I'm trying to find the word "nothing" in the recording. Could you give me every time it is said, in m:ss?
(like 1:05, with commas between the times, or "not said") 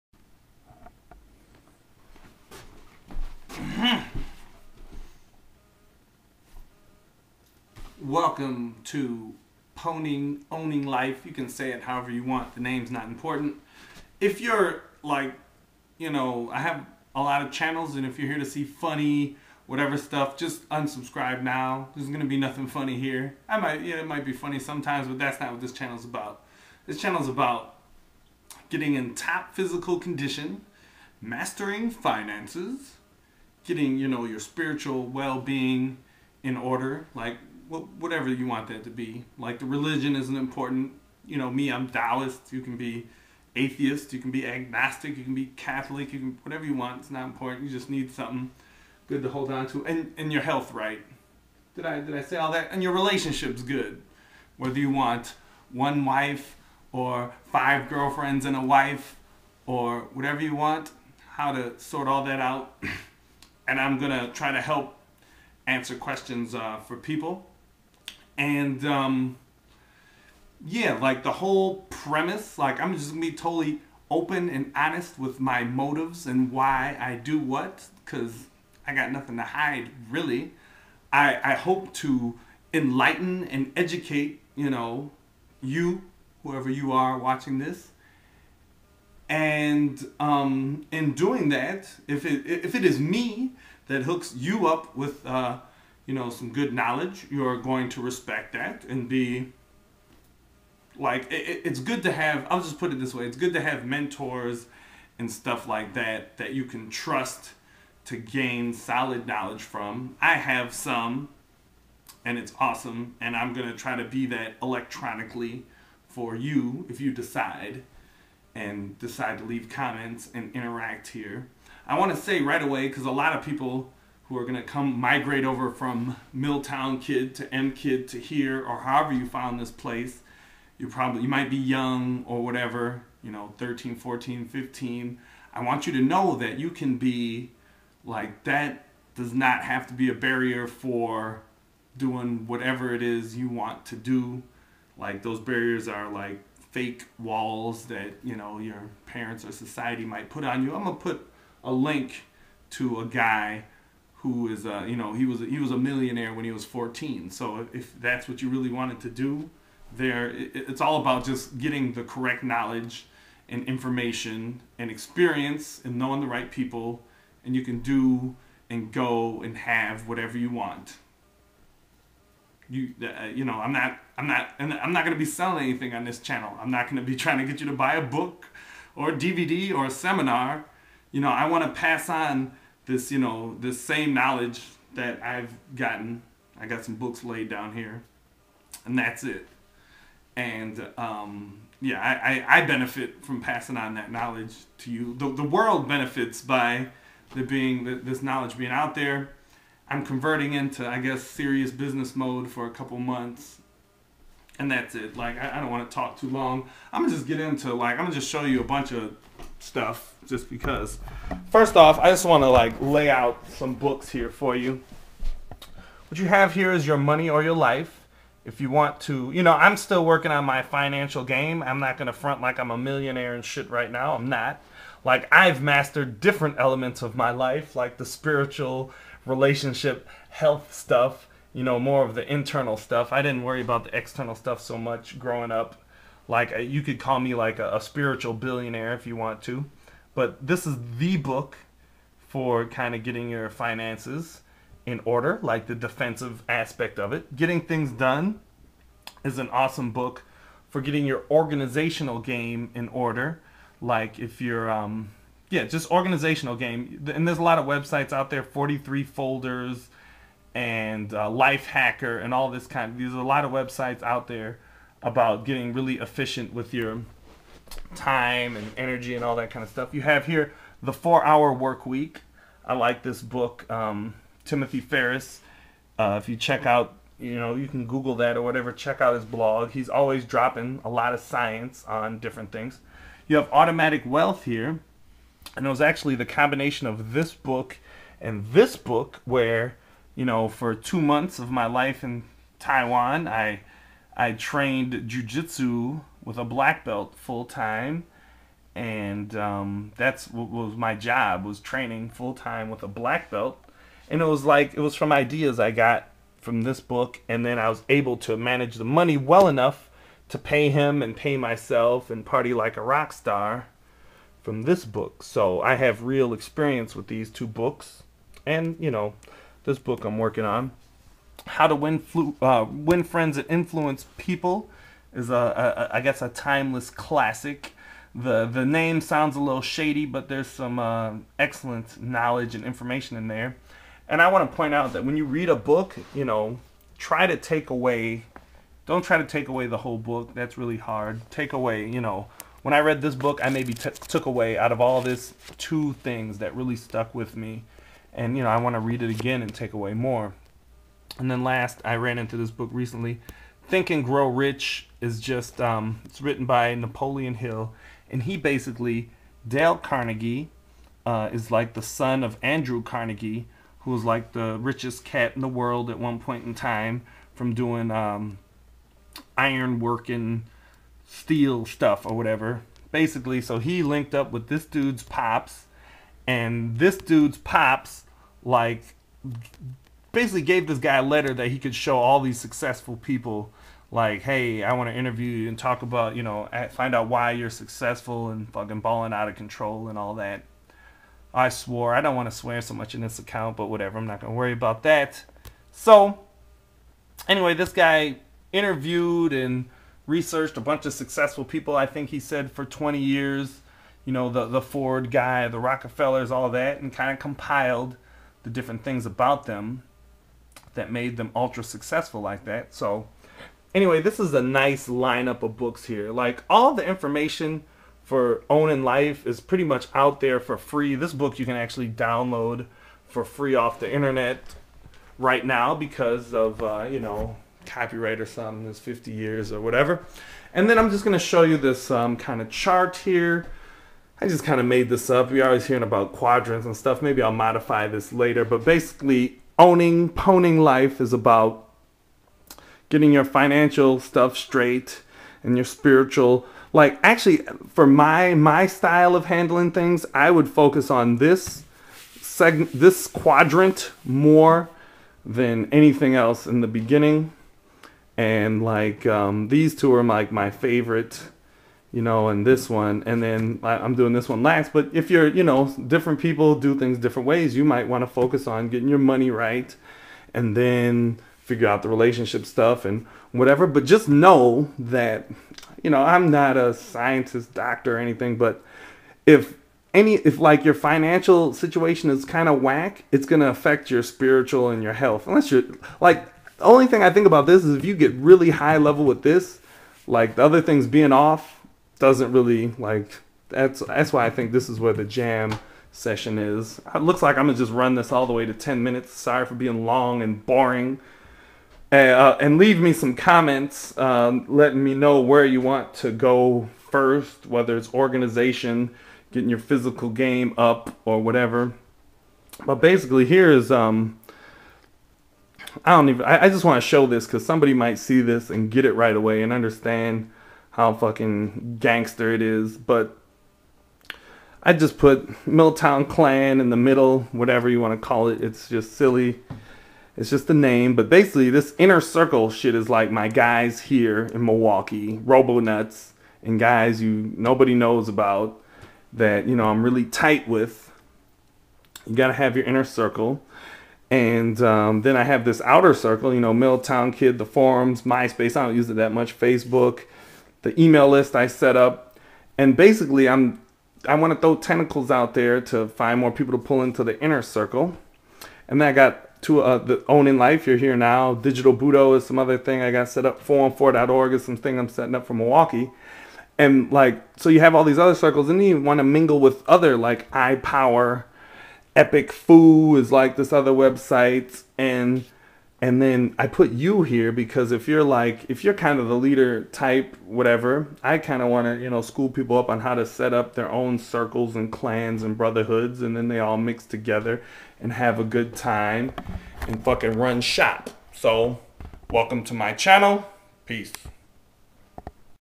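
0:22, 1:19.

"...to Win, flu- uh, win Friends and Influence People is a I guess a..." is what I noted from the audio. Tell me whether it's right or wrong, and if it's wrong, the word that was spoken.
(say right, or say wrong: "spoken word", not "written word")
right.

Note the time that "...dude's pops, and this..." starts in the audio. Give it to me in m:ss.
6:14.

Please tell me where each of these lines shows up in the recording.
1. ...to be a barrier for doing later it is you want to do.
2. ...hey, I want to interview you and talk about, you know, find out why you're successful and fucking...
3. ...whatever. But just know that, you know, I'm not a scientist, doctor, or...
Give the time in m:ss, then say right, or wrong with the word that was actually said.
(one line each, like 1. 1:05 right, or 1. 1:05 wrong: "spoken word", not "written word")
1. 2:19 wrong: "whatever", not "later"
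2. 6:24 right
3. 7:53 right.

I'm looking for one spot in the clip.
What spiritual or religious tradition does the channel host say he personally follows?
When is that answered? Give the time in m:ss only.
0:41.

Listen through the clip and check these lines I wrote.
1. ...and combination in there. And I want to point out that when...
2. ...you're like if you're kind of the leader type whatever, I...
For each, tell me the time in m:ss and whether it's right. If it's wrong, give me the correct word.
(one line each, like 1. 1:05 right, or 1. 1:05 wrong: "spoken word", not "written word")
1. 5:32 wrong: "information", not "combination"
2. 9:37 right.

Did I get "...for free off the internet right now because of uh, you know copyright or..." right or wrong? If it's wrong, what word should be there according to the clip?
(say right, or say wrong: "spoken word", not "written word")
right.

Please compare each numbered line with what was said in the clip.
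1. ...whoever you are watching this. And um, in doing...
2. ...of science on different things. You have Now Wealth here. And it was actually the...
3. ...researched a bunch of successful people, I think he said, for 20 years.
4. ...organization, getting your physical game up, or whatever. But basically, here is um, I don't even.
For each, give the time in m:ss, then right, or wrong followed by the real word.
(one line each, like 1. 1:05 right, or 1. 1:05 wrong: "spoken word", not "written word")
1. 1:26 right
2. 4:41 wrong: "Automatic", not "Now"
3. 6:40 right
4. 8:27 right.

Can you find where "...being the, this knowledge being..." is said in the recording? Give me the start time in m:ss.
3:17.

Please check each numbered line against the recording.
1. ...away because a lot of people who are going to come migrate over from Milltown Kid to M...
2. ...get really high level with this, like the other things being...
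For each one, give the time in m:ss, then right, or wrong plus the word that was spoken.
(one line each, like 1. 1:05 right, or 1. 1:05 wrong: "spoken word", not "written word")
1. 2:02 right
2. 8:07 right.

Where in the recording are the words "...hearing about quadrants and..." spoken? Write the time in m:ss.
7:15.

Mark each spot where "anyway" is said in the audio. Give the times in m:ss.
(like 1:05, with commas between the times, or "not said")
6:37, 6:53.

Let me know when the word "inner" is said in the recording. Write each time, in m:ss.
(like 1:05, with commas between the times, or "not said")
8:51, 9:02, 9:17.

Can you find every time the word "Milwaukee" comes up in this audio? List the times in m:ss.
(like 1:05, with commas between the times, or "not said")
8:54, 9:25.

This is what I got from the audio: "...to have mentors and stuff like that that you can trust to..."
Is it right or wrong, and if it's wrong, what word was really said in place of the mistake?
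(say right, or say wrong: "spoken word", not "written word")
right.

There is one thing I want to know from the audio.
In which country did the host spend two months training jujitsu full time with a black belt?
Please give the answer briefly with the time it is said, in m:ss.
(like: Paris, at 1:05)
Taiwan, at 4:52.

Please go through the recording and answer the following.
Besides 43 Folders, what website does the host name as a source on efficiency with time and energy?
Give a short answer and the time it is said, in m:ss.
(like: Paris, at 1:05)
Lifehacker, at 4:21.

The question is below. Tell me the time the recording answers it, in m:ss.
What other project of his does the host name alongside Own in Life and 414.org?
9:21.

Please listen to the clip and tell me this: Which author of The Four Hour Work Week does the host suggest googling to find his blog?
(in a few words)
Timothy Ferriss.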